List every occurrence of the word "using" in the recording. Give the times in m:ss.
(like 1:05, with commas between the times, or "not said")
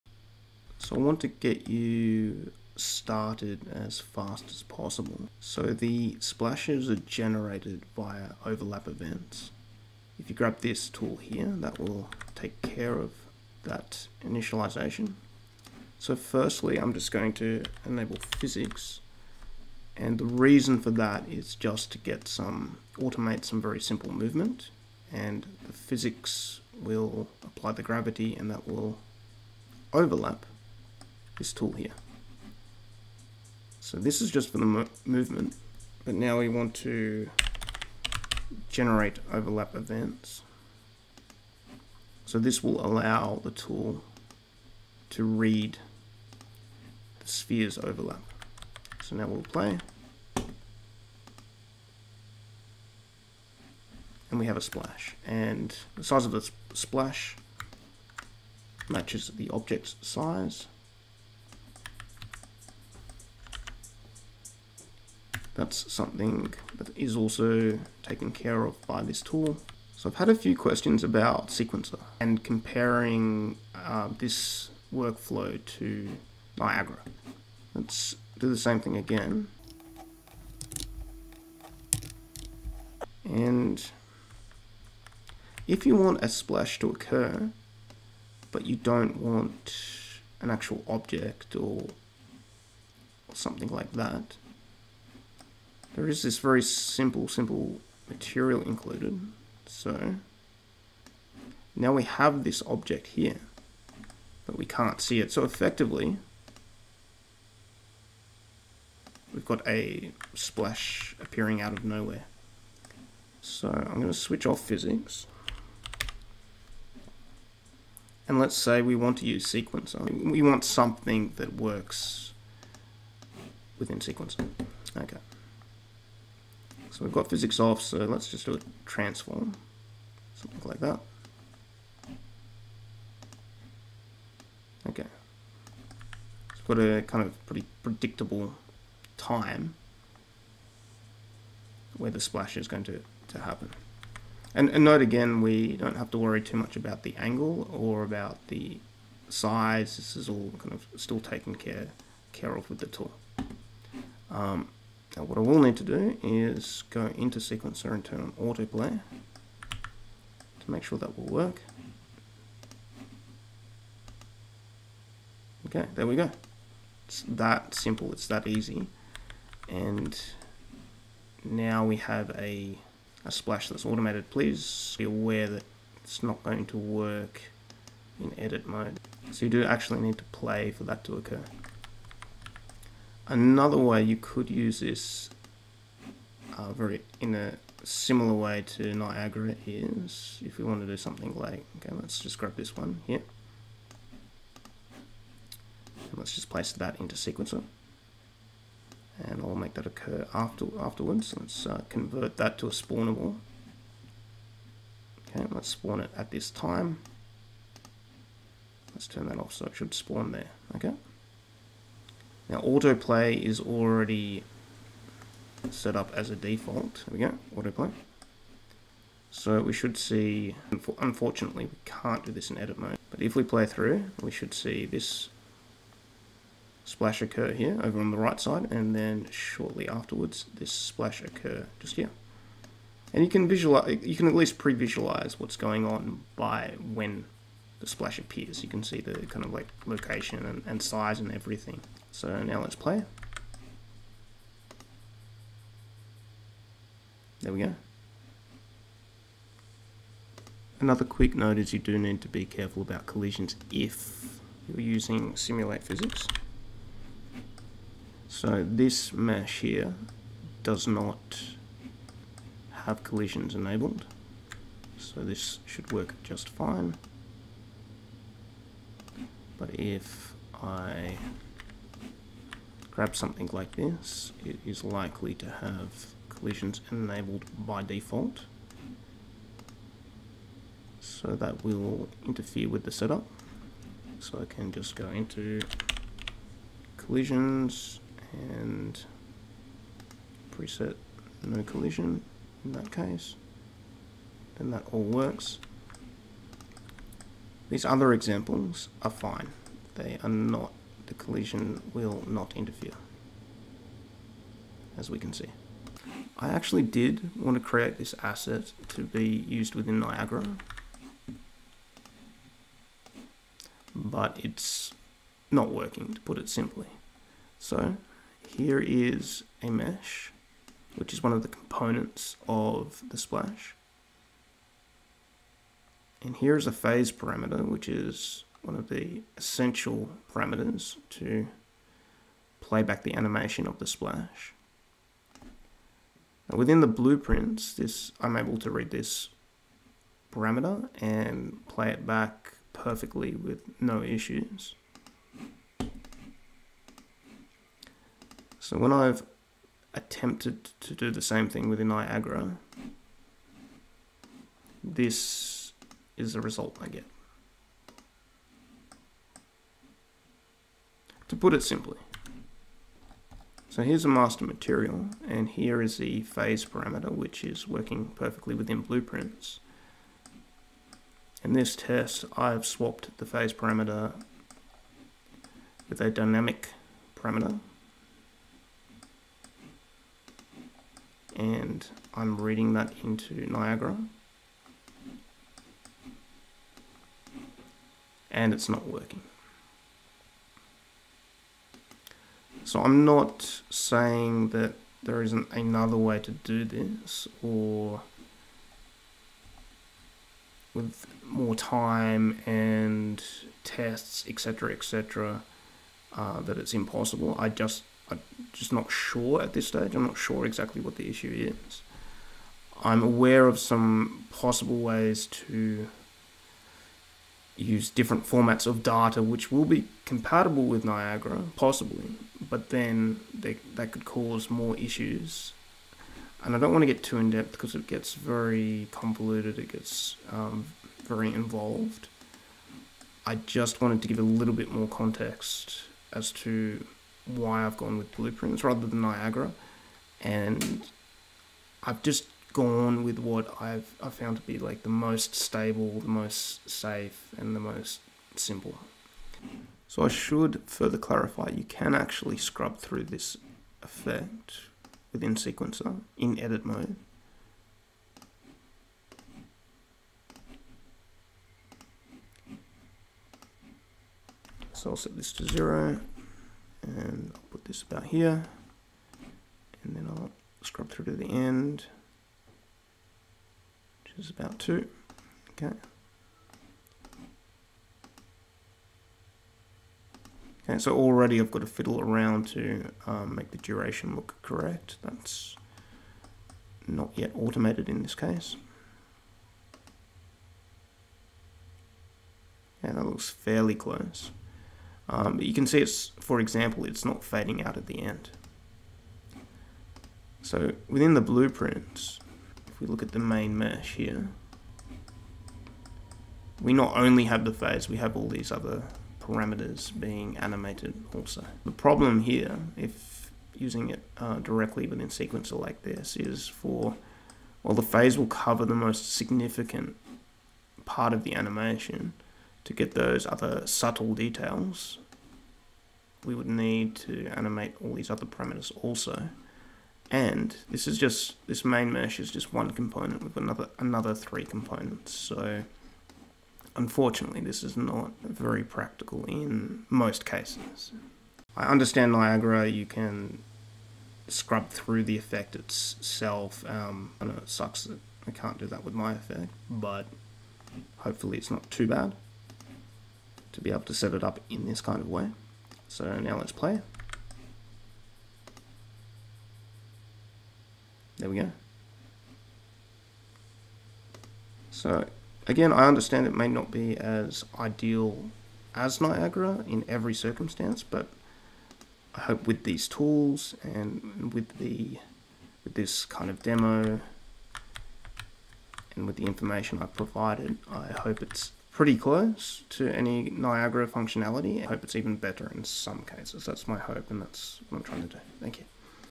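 4:14, 8:33.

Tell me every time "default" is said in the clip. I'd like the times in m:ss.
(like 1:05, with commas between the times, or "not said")
3:36, 4:37.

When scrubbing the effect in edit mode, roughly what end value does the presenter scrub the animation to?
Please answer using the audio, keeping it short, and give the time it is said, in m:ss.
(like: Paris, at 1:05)
2, at 7:54.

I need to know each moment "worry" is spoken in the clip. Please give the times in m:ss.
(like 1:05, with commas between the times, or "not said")
2:26.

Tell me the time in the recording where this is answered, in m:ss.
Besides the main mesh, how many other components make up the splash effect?
8:54.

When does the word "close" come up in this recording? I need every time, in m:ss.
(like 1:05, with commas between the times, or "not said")
8:13, 9:41.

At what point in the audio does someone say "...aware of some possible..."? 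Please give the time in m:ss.
6:53.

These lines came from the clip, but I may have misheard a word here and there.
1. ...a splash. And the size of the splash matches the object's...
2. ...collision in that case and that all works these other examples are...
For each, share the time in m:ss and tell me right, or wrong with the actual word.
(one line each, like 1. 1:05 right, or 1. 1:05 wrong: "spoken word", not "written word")
1. 0:54 right
2. 4:51 right.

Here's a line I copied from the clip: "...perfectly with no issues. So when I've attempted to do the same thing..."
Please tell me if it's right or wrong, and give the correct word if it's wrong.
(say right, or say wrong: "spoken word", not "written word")
right.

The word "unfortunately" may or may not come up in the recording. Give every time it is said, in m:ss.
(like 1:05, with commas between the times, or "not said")
3:40, 8:56.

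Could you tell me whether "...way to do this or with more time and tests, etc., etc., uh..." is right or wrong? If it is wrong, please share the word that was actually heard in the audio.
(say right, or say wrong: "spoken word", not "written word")
right.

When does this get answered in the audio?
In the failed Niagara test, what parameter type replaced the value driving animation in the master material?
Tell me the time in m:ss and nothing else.
6:16.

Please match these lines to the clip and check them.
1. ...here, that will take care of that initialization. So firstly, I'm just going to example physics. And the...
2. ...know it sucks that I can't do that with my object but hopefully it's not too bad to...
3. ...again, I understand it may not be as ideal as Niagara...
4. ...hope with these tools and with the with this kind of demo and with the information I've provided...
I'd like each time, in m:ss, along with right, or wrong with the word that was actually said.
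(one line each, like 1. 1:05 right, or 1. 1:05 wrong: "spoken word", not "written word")
1. 0:11 wrong: "enable", not "example"
2. 9:07 wrong: "effect", not "object"
3. 9:25 right
4. 9:32 right.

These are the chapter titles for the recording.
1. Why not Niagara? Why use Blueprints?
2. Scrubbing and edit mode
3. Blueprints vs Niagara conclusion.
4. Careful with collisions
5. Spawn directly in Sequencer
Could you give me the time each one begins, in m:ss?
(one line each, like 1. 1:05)
1. 5:04
2. 7:29
3. 9:00
4. 4:10
5. 3:08.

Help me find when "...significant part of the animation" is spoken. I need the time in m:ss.
8:39.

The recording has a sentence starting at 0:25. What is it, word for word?
And the physics will apply the gravity and that will overlap this tool here.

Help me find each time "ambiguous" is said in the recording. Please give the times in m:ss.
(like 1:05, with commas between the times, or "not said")
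not said.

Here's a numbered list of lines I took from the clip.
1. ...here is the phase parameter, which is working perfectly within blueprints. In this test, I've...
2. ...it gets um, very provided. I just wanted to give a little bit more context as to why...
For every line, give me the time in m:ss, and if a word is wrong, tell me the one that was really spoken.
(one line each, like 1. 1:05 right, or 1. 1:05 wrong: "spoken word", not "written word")
1. 6:05 right
2. 7:09 wrong: "involved", not "provided".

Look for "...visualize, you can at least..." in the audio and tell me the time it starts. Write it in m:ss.
3:53.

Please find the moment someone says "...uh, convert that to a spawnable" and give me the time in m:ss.
3:21.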